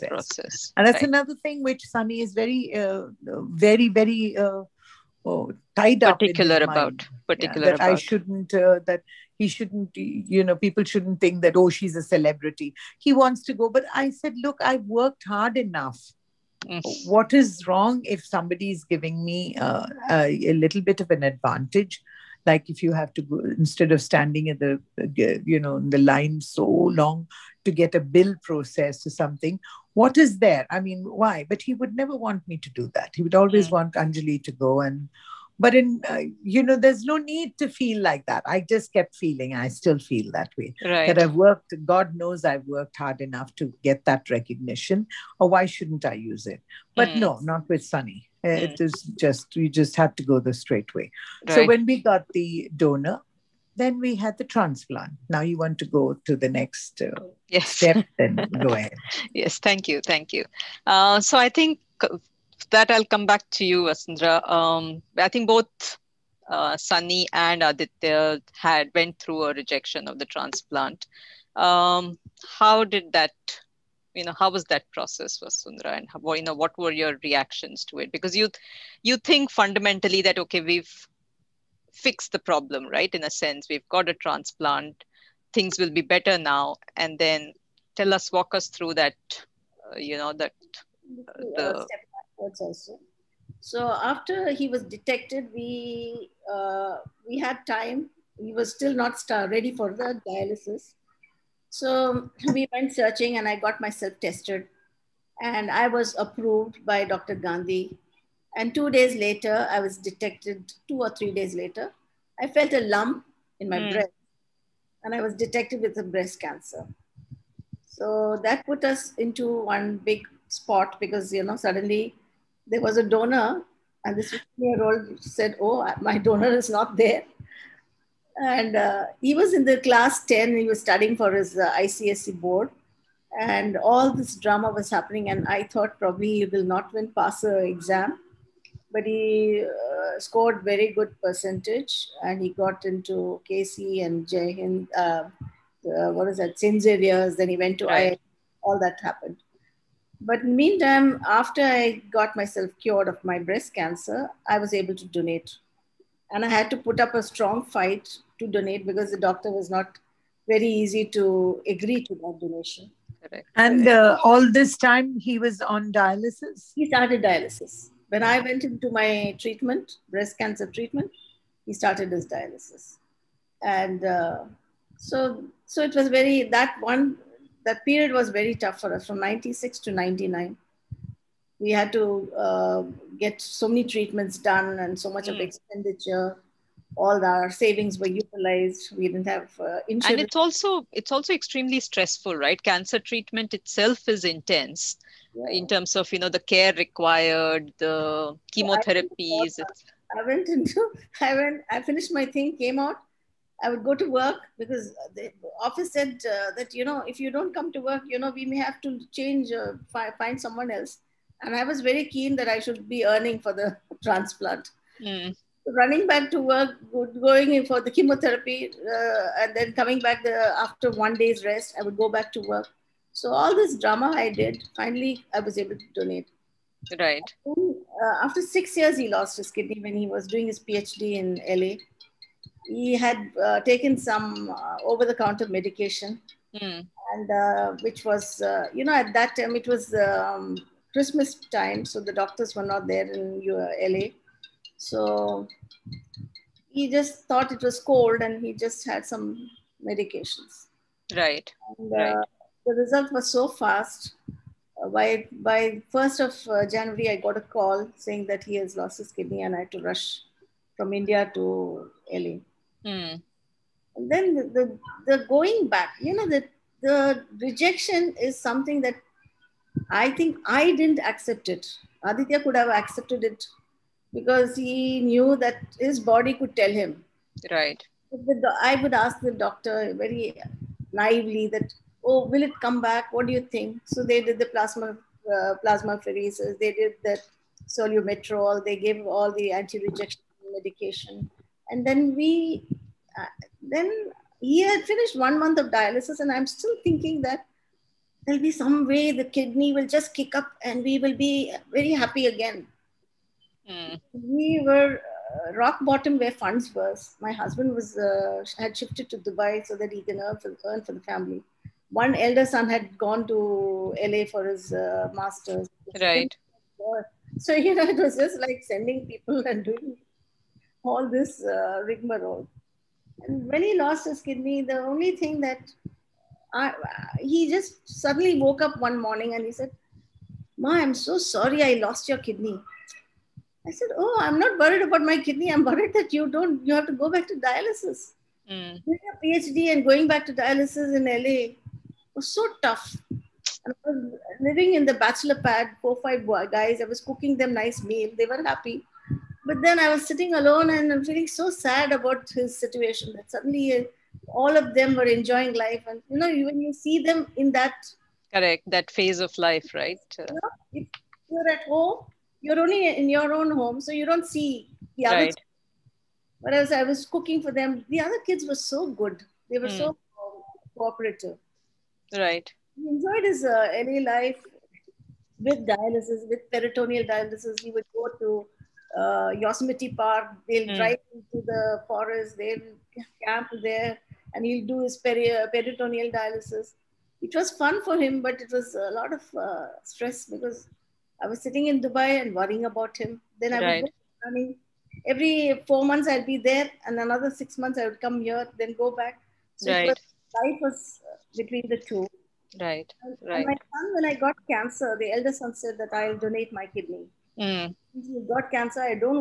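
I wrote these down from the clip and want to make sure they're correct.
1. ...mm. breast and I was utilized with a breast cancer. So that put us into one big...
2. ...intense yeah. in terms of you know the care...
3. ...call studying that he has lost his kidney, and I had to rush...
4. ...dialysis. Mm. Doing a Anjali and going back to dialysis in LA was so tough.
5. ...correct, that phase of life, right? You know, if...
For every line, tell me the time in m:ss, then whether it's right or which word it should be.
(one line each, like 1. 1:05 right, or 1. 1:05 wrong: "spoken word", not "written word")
1. 1:53 wrong: "detected", not "utilized"
2. 3:14 right
3. 4:17 wrong: "saying", not "studying"
4. 5:37 wrong: "PhD", not "Anjali"
5. 5:58 right.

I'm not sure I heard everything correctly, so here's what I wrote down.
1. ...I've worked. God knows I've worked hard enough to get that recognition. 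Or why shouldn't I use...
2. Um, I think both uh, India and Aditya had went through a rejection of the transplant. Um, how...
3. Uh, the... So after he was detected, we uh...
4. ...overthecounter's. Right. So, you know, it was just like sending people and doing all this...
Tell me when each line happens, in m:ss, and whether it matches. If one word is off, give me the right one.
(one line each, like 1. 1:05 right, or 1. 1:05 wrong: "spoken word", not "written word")
1. 0:41 right
2. 1:04 wrong: "Sunny", not "India"
3. 1:31 right
4. 5:15 wrong: "master", not "overthecounter".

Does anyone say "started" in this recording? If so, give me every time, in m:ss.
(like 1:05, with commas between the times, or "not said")
2:46, 2:51.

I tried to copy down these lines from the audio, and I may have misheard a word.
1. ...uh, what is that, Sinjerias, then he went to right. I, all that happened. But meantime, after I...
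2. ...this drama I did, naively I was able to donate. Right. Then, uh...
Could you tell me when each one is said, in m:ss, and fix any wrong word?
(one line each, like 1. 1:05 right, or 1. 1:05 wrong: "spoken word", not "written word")
1. 2:25 right
2. 3:43 wrong: "finally", not "naively".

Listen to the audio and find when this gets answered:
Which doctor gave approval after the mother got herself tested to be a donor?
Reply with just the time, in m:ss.
1:47.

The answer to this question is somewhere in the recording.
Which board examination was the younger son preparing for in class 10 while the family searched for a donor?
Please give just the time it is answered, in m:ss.
2:11.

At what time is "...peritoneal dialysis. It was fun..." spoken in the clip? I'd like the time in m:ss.
6:25.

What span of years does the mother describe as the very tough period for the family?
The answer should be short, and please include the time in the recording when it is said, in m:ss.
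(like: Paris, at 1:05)
96 to 99, at 2:59.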